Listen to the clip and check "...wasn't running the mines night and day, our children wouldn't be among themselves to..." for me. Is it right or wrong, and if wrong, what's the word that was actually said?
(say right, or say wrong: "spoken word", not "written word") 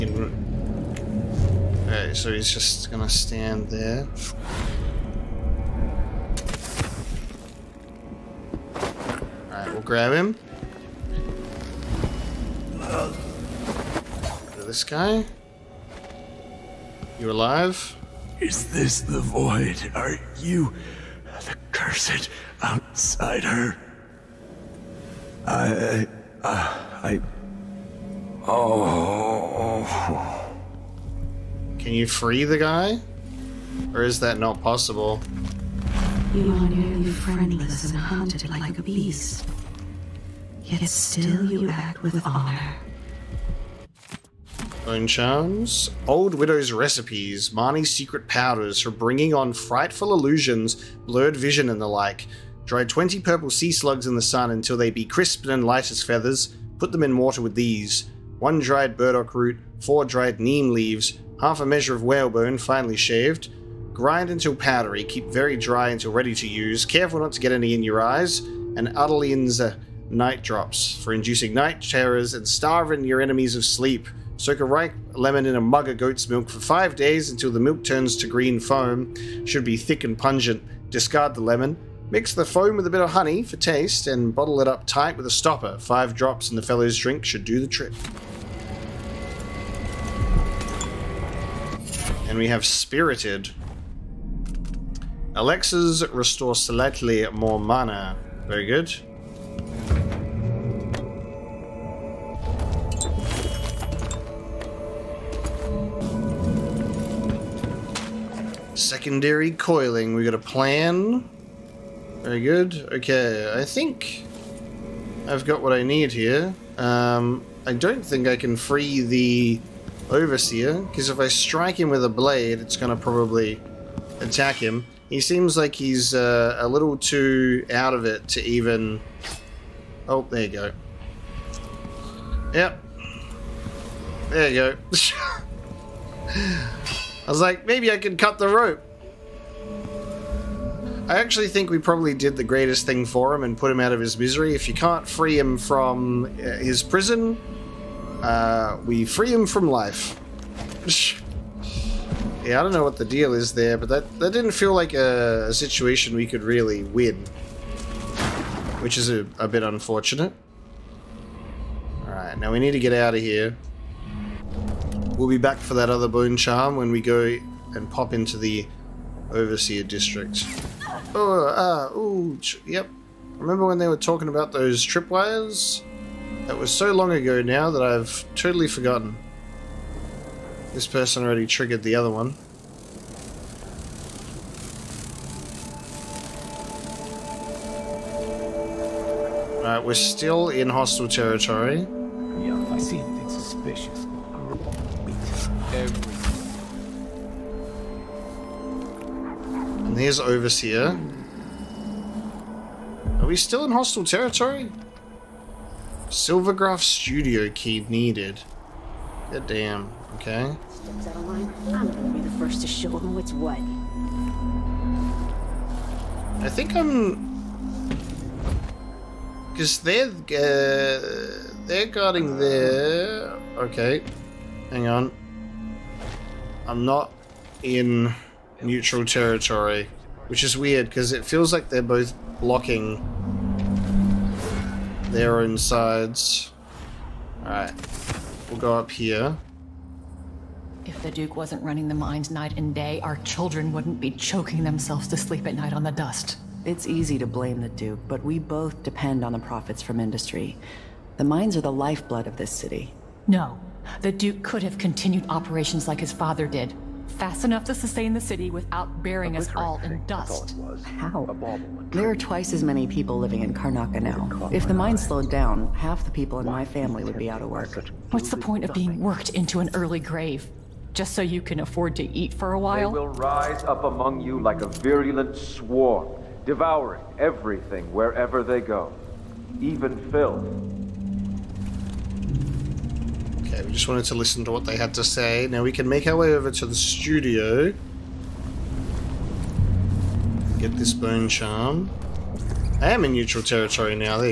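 wrong: "choking", not "among".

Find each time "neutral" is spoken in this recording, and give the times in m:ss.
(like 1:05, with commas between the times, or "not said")
3:48, 4:53.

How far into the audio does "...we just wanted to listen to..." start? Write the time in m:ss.
4:43.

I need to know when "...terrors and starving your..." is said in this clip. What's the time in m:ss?
1:11.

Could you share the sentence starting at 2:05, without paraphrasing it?
He seems like he's uh, a little too out of it to even...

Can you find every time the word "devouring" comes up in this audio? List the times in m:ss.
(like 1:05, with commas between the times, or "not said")
4:36.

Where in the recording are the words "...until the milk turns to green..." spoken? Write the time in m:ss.
1:17.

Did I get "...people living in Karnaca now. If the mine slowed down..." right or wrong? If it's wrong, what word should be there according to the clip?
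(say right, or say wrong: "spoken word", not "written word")
right.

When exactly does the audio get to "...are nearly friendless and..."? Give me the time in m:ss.
0:36.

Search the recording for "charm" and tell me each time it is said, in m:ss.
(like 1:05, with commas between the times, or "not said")
0:45, 2:46, 4:51.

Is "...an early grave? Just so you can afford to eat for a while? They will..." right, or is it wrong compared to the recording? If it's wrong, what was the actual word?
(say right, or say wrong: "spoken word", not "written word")
right.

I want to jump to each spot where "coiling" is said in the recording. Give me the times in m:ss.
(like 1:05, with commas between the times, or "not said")
1:49.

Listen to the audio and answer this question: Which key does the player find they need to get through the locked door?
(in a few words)
Silvergraph studio key.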